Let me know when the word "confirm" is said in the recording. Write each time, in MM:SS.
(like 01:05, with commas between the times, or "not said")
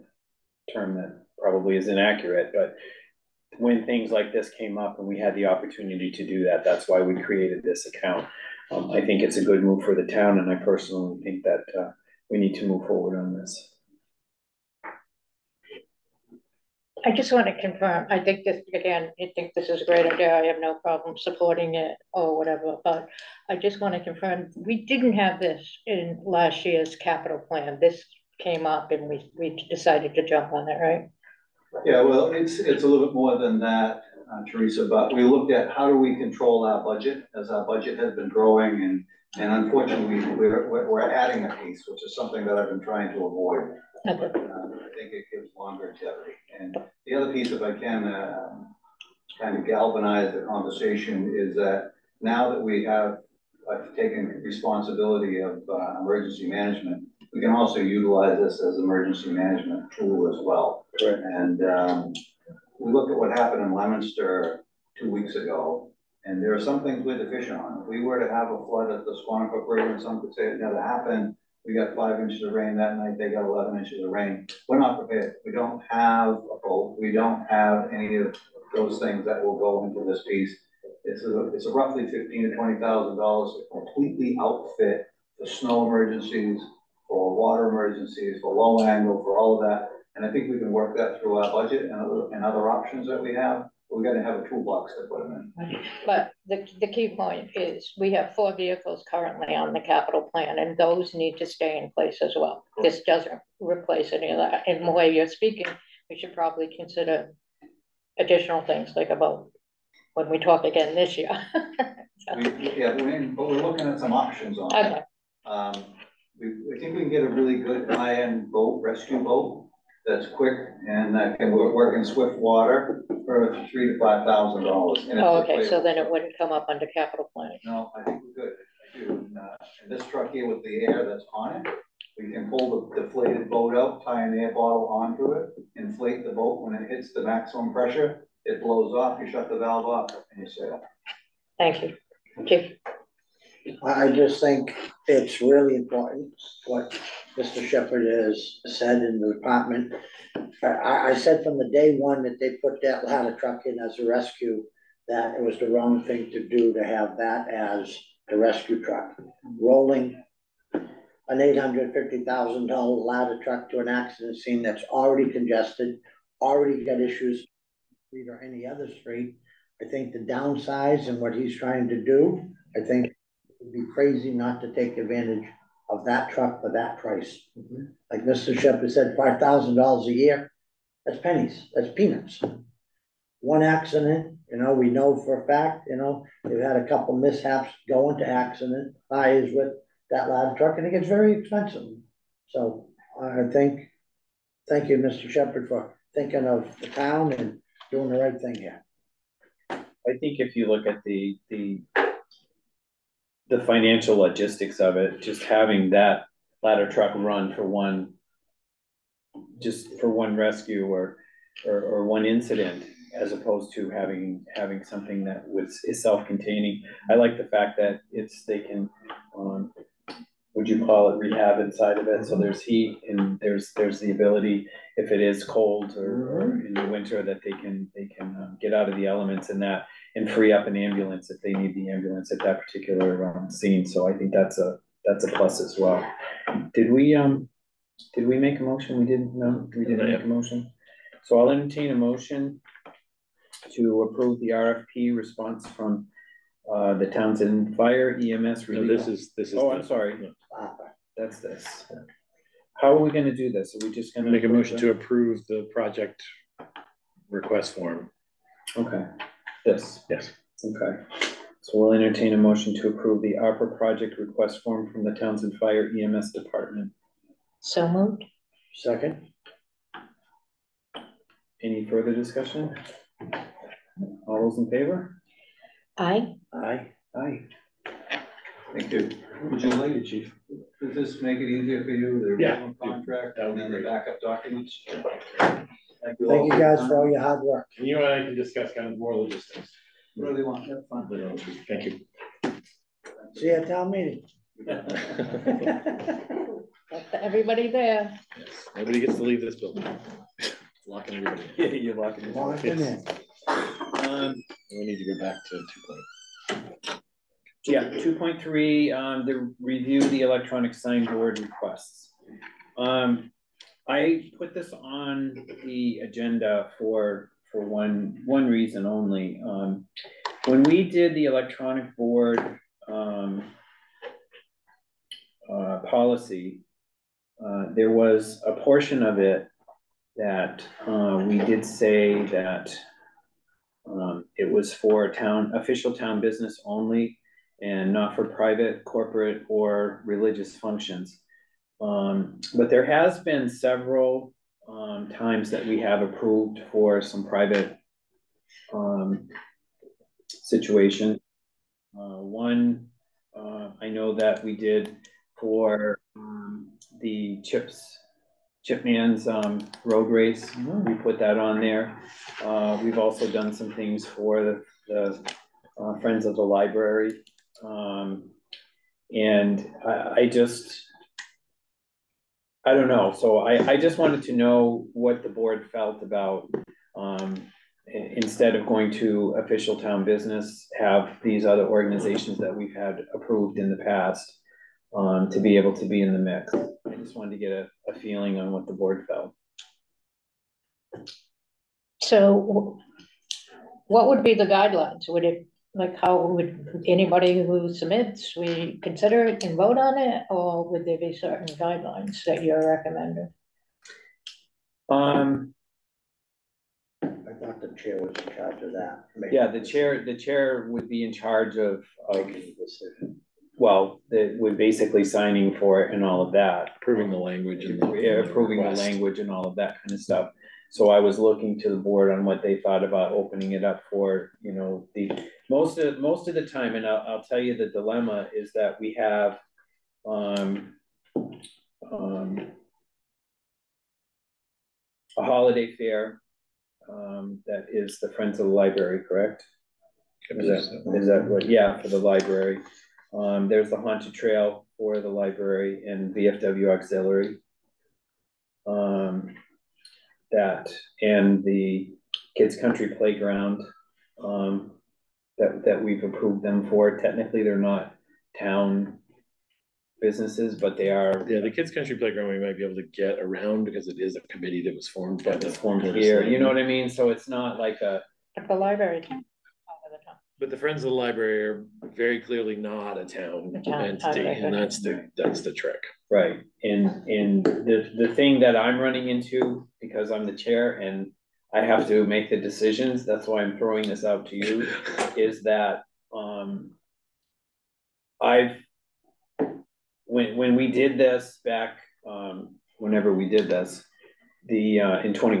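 00:17, 00:24.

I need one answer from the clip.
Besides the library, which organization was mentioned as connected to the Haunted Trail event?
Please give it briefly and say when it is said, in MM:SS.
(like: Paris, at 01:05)
VFW Auxiliary, at 07:26.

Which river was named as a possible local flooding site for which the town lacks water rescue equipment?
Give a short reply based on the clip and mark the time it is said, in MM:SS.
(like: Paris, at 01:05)
Squanicook River, at 01:09.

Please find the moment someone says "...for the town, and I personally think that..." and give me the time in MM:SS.
00:09.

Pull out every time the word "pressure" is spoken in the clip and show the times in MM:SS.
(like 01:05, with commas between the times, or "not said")
02:17.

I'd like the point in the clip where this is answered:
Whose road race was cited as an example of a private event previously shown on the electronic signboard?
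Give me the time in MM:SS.
05:58.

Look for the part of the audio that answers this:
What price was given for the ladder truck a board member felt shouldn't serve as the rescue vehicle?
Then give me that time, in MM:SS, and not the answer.
02:41.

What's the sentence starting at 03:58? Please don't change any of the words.
We didn't no, we didn't make a motion.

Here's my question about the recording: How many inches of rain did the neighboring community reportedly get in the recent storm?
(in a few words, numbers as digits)
11.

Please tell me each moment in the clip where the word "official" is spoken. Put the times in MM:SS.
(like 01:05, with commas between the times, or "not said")
05:35, 06:19.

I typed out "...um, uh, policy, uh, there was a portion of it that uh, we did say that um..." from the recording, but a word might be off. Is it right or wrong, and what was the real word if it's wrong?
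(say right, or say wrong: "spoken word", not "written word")
right.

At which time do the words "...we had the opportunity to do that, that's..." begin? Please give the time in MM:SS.
00:05.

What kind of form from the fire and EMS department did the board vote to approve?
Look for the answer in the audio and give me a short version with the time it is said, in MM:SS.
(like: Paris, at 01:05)
ARPA project request form, at 04:23.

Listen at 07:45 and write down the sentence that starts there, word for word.
was formed here, you know what I mean?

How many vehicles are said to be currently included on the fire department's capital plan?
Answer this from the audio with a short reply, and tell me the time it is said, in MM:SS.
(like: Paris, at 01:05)
4, at 01:38.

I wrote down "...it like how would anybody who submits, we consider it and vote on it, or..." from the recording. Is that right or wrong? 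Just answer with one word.
right.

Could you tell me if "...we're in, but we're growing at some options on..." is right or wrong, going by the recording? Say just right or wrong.
wrong.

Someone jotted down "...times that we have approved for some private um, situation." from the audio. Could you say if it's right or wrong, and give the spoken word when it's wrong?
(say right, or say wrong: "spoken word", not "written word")
right.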